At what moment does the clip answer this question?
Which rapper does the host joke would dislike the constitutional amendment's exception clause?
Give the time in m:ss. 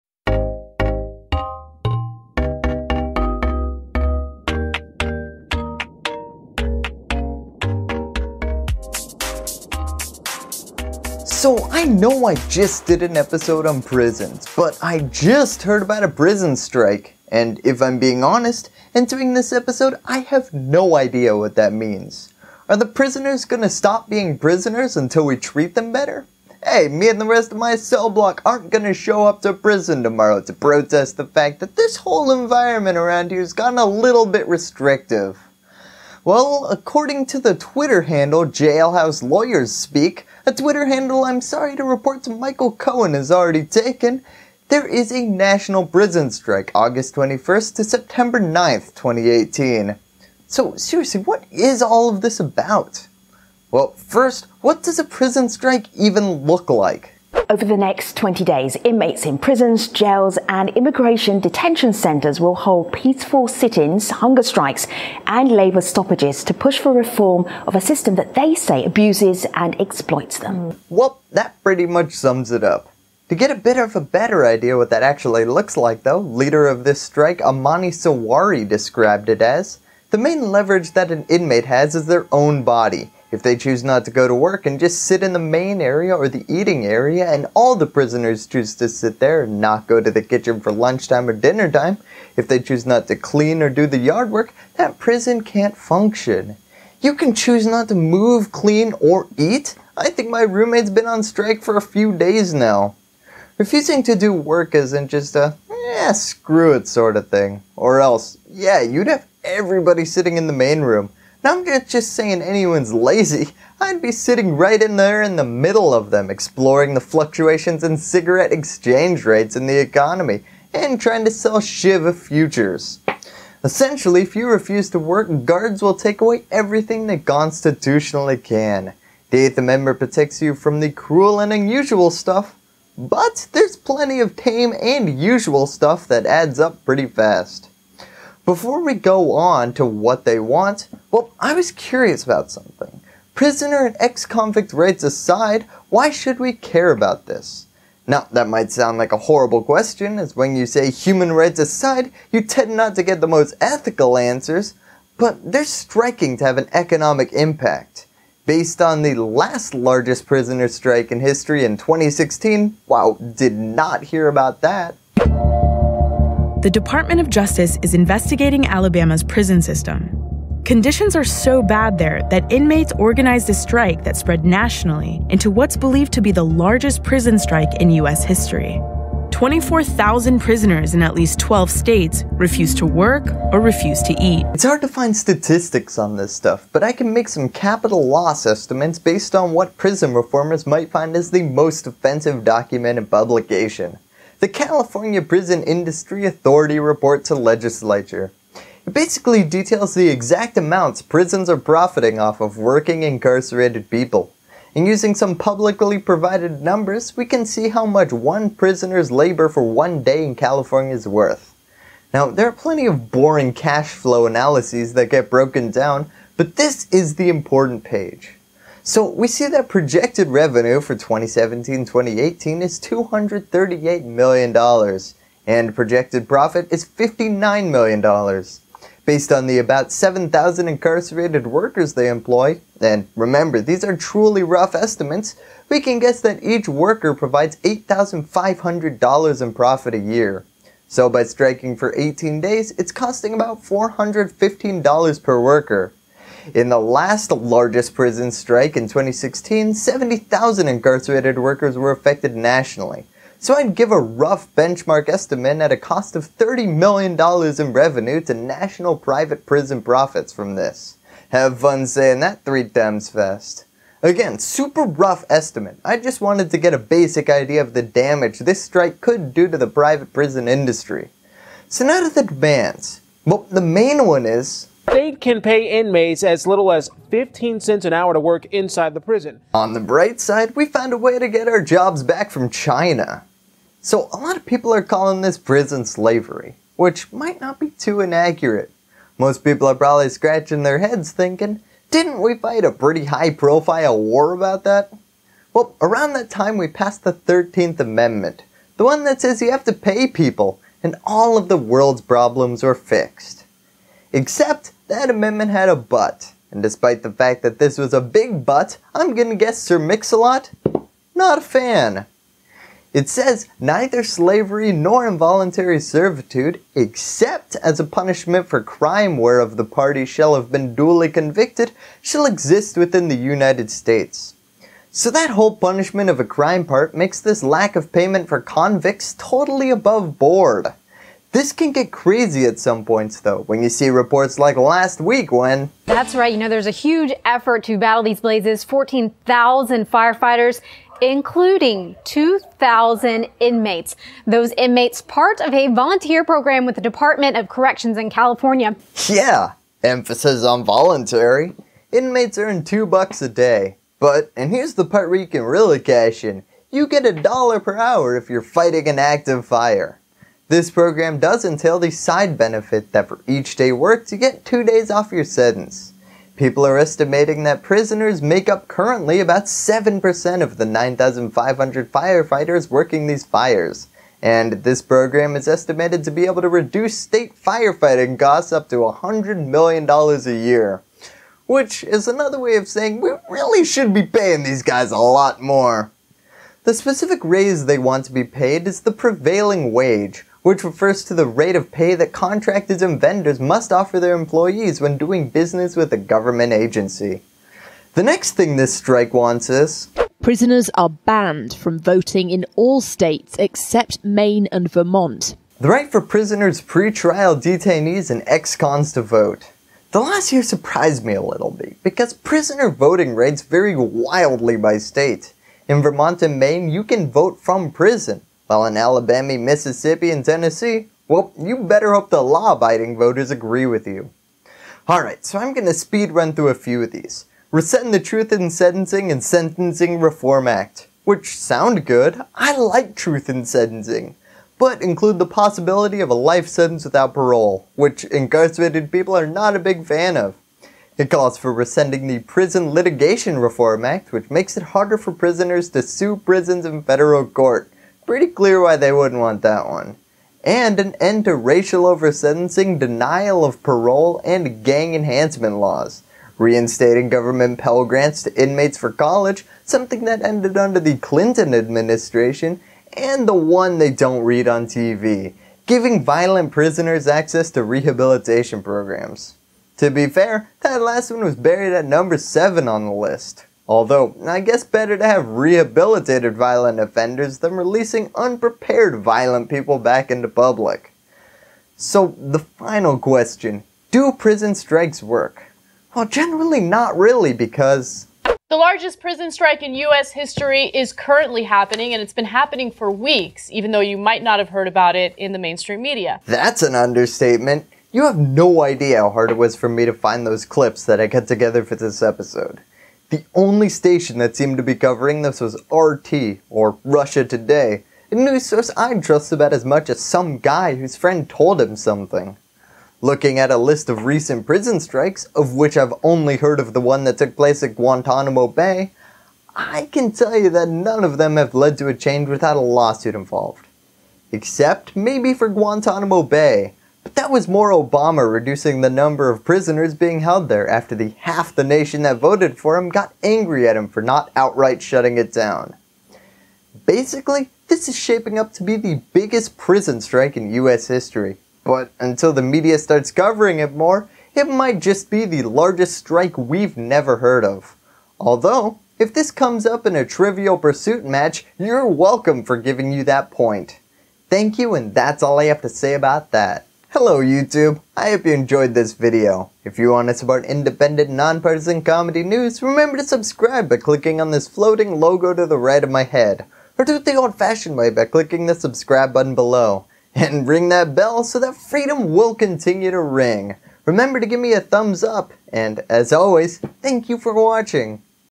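5:09.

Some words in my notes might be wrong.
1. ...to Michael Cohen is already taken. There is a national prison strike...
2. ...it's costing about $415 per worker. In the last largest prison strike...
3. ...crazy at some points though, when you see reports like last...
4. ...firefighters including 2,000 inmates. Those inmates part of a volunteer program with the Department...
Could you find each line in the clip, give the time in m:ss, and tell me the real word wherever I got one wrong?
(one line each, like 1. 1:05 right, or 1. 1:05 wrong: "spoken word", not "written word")
1. 0:42 right
2. 4:02 right
3. 5:31 right
4. 5:39 right.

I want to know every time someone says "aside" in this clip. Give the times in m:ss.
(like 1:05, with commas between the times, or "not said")
2:25, 2:31.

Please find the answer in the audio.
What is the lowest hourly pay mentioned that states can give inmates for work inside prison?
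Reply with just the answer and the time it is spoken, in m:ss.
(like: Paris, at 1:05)
15 cents, at 4:37.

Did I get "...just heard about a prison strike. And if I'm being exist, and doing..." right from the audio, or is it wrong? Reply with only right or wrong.
wrong.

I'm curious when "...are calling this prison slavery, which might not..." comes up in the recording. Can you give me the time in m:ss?
4:44.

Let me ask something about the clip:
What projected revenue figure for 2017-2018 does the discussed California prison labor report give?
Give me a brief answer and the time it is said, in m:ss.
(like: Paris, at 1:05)
$238 million, at 3:42.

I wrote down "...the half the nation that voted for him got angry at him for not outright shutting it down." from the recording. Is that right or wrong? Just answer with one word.
right.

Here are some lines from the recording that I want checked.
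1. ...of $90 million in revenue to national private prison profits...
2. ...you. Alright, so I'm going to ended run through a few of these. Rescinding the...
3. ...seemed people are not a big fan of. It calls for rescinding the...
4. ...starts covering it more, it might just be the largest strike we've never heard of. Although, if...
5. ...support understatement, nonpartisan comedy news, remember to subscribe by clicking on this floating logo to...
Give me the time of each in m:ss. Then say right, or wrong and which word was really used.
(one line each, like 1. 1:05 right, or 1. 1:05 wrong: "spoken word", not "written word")
1. 4:16 wrong: "30", not "90"
2. 7:03 wrong: "speed", not "ended"
3. 7:18 wrong: "incarcerated", not "seemed"
4. 9:02 right
5. 9:20 wrong: "independent", not "understatement".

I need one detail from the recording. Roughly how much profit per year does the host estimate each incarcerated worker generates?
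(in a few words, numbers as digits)
$8,500.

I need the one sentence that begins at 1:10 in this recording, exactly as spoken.
Well, that pretty much sums it up.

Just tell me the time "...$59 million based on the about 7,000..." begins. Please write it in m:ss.
3:46.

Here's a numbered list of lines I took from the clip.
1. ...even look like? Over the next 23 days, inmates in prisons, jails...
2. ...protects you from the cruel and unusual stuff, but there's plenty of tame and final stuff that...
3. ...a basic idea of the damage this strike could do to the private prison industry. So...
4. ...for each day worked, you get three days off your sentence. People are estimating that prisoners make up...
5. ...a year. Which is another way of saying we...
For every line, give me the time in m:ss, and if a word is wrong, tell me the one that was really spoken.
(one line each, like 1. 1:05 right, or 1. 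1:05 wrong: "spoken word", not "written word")
1. 0:55 wrong: "20", not "23"
2. 2:09 wrong: "usual", not "final"
3. 4:26 right
4. 6:03 wrong: "two", not "three"
5. 6:19 right.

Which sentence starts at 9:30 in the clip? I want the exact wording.
And ring that bell so that freedom will continue to ring.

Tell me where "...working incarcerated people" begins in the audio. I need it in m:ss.
3:22.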